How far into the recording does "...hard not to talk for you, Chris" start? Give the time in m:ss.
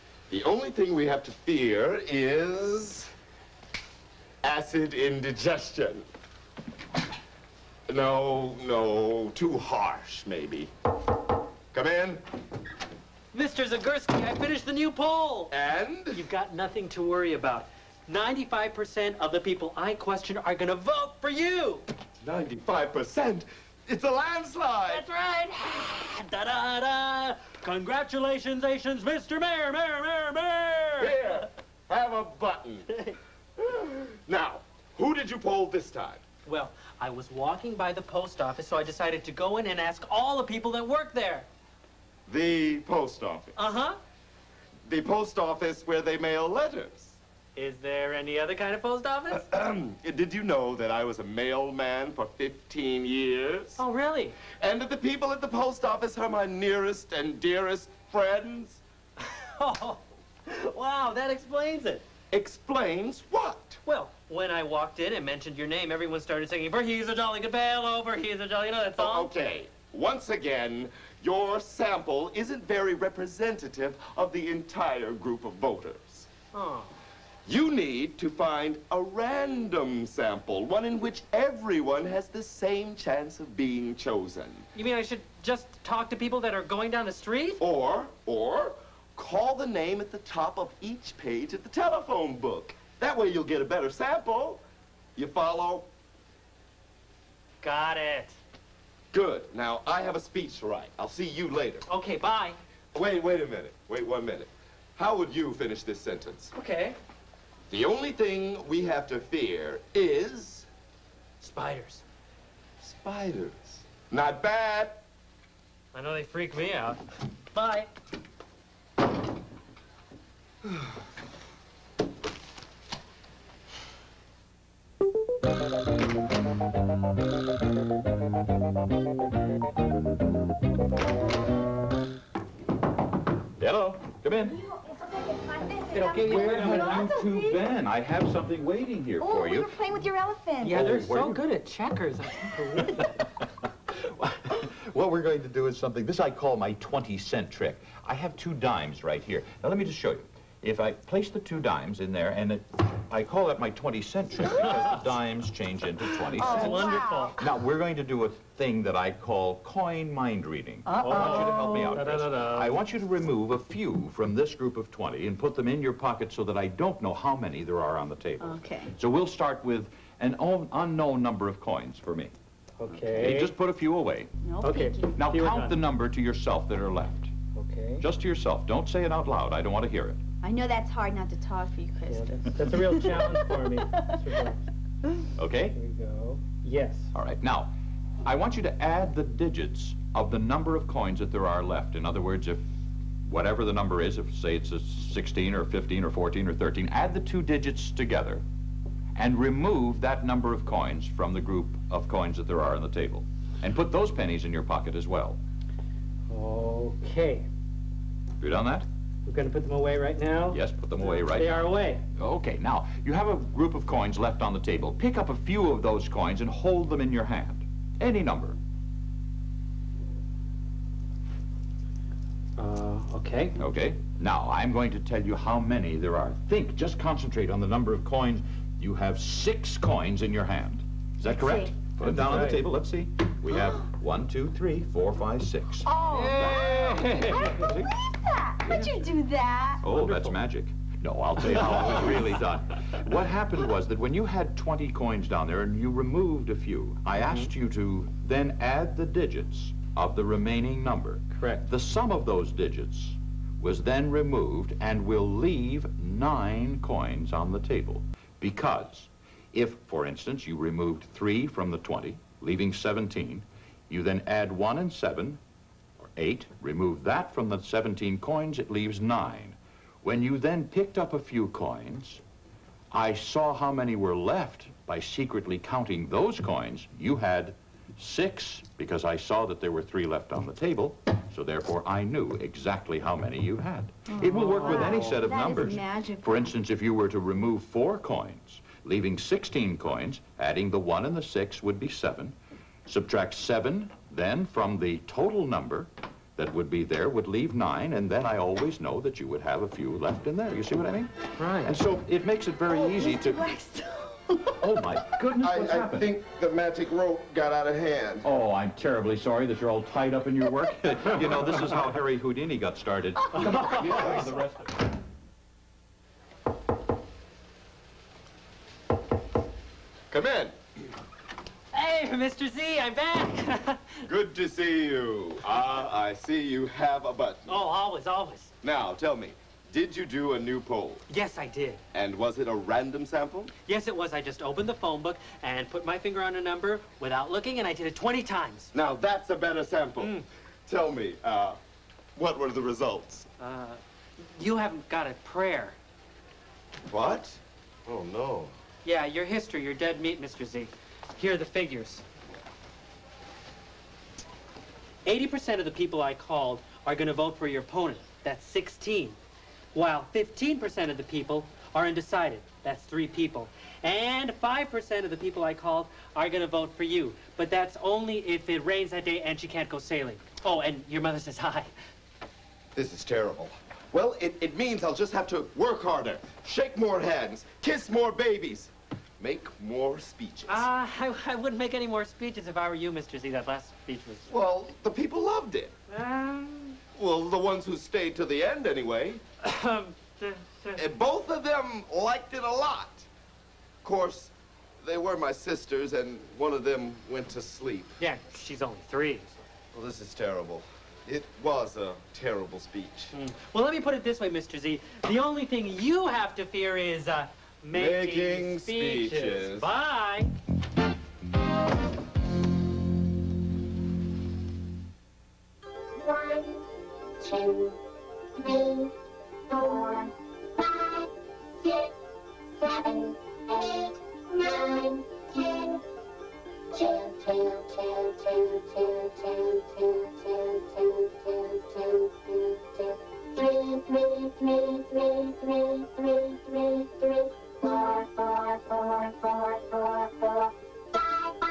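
3:00.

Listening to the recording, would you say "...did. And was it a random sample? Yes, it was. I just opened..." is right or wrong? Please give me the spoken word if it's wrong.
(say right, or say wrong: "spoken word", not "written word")
right.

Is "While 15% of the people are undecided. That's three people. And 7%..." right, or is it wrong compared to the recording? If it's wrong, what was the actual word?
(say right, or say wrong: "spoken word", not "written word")
wrong: "5", not "7".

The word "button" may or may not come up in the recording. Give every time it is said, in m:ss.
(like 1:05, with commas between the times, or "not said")
0:32, 5:27.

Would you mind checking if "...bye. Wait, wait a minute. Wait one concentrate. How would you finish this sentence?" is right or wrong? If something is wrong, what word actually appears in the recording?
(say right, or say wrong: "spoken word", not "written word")
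wrong: "minute", not "concentrate".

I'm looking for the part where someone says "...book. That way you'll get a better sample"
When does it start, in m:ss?
1:32.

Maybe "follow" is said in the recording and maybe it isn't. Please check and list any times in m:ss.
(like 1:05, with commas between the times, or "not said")
1:35.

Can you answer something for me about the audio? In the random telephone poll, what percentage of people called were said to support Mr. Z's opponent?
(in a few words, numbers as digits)
80%.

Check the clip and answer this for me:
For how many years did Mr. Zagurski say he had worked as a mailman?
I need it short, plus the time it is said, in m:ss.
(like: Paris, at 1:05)
15, at 0:52.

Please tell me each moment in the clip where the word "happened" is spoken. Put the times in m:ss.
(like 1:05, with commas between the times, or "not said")
4:03, 5:05.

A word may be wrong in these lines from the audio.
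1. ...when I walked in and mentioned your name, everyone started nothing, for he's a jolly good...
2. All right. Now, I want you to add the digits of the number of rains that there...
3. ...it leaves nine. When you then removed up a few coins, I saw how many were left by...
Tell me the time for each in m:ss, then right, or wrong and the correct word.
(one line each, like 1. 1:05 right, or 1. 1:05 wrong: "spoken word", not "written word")
1. 1:04 wrong: "singing", not "nothing"
2. 3:07 wrong: "coins", not "rains"
3. 4:28 wrong: "picked", not "removed".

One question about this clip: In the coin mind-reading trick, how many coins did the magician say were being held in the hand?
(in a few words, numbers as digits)
6.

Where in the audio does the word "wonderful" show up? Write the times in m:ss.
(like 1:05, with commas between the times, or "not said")
2:36, 4:00.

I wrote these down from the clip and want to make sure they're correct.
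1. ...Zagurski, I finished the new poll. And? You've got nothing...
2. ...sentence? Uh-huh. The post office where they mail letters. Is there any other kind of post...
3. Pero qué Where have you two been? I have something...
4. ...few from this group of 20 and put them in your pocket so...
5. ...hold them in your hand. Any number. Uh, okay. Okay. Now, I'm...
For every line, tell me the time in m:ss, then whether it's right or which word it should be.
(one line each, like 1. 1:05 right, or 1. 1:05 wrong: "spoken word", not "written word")
1. 0:13 right
2. 0:43 wrong: "office", not "sentence"
3. 2:15 right
4. 2:43 right
5. 3:36 right.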